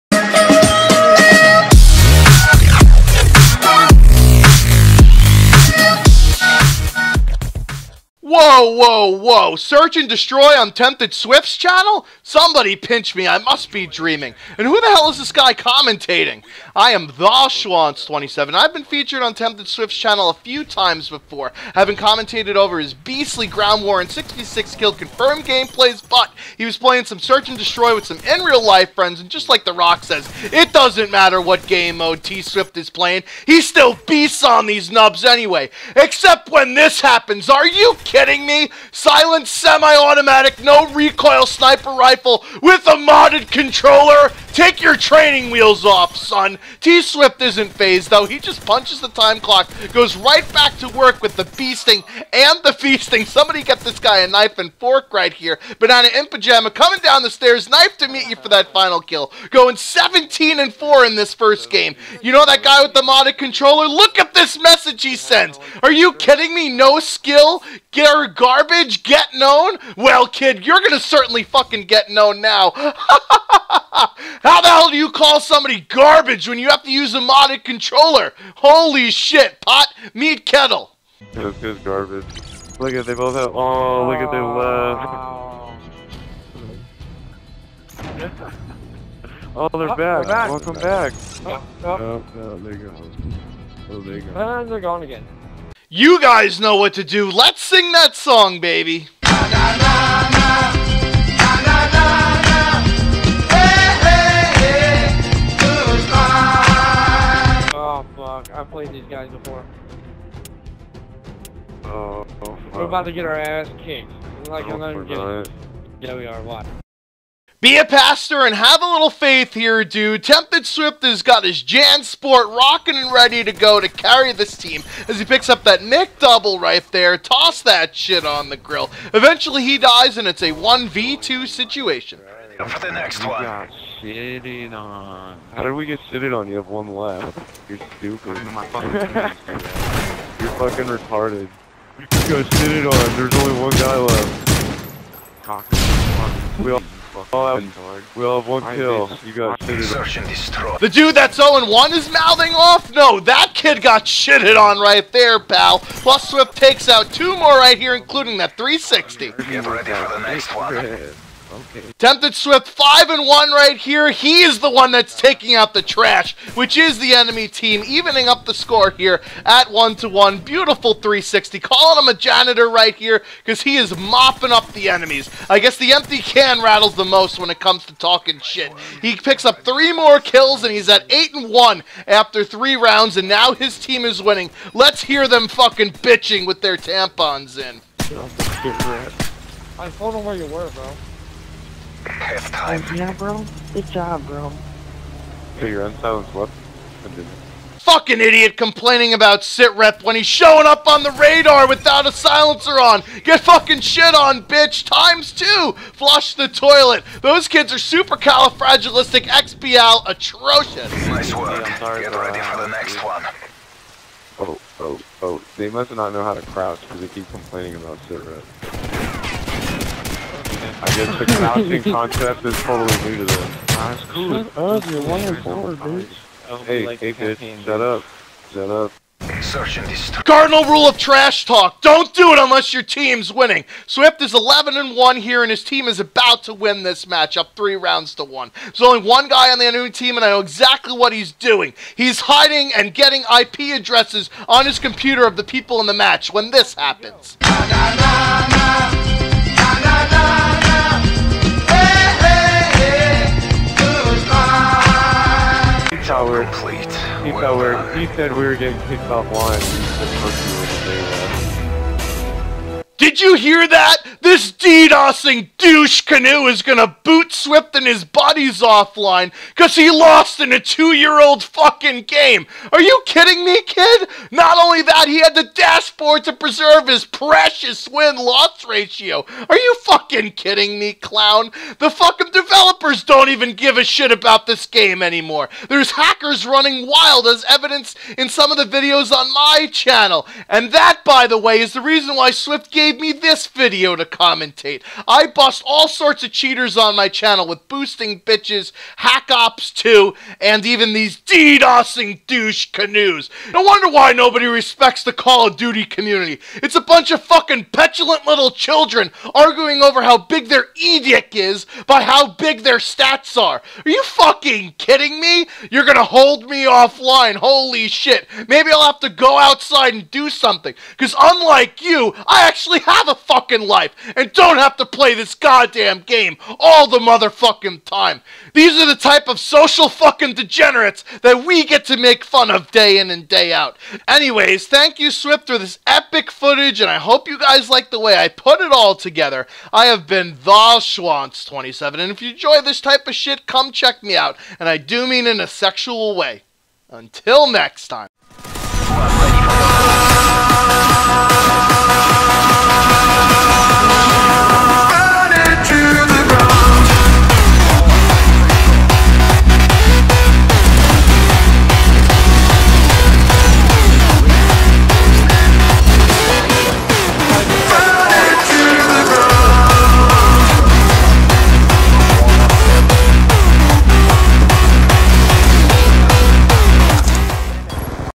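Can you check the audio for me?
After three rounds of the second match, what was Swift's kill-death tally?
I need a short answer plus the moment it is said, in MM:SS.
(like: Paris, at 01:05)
8 and 1, at 03:01.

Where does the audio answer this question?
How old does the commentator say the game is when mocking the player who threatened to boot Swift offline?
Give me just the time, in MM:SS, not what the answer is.
04:30.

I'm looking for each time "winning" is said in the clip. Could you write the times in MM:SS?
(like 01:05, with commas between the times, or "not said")
03:04, 03:53.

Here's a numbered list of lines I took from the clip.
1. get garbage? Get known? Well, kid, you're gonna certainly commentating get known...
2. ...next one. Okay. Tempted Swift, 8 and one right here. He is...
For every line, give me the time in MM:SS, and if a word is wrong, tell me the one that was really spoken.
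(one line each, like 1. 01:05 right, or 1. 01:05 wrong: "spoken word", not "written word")
1. 01:07 wrong: "fucking", not "commentating"
2. 02:40 wrong: "5", not "8".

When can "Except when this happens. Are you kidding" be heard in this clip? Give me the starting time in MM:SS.
00:35.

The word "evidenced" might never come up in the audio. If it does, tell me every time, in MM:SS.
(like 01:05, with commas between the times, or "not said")
04:47.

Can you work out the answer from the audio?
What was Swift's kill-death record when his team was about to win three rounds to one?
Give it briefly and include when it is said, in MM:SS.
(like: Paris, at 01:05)
11 and 1, at 03:54.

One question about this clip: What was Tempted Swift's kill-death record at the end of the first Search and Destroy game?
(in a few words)
17 and 4.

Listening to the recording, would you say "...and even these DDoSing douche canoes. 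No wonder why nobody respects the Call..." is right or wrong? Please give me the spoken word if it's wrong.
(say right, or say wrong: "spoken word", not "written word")
right.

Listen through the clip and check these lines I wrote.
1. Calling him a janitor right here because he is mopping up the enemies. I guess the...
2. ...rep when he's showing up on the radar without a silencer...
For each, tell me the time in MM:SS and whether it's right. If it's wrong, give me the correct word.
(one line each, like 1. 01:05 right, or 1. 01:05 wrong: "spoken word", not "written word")
1. 02:51 right
2. 03:19 right.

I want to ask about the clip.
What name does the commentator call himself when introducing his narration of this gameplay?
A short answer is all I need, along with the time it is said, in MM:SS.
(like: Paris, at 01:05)
Shwantz27, at 00:16.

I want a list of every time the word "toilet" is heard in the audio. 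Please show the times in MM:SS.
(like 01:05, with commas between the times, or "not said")
03:26.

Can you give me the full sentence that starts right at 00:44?
Take your training wheels off, son!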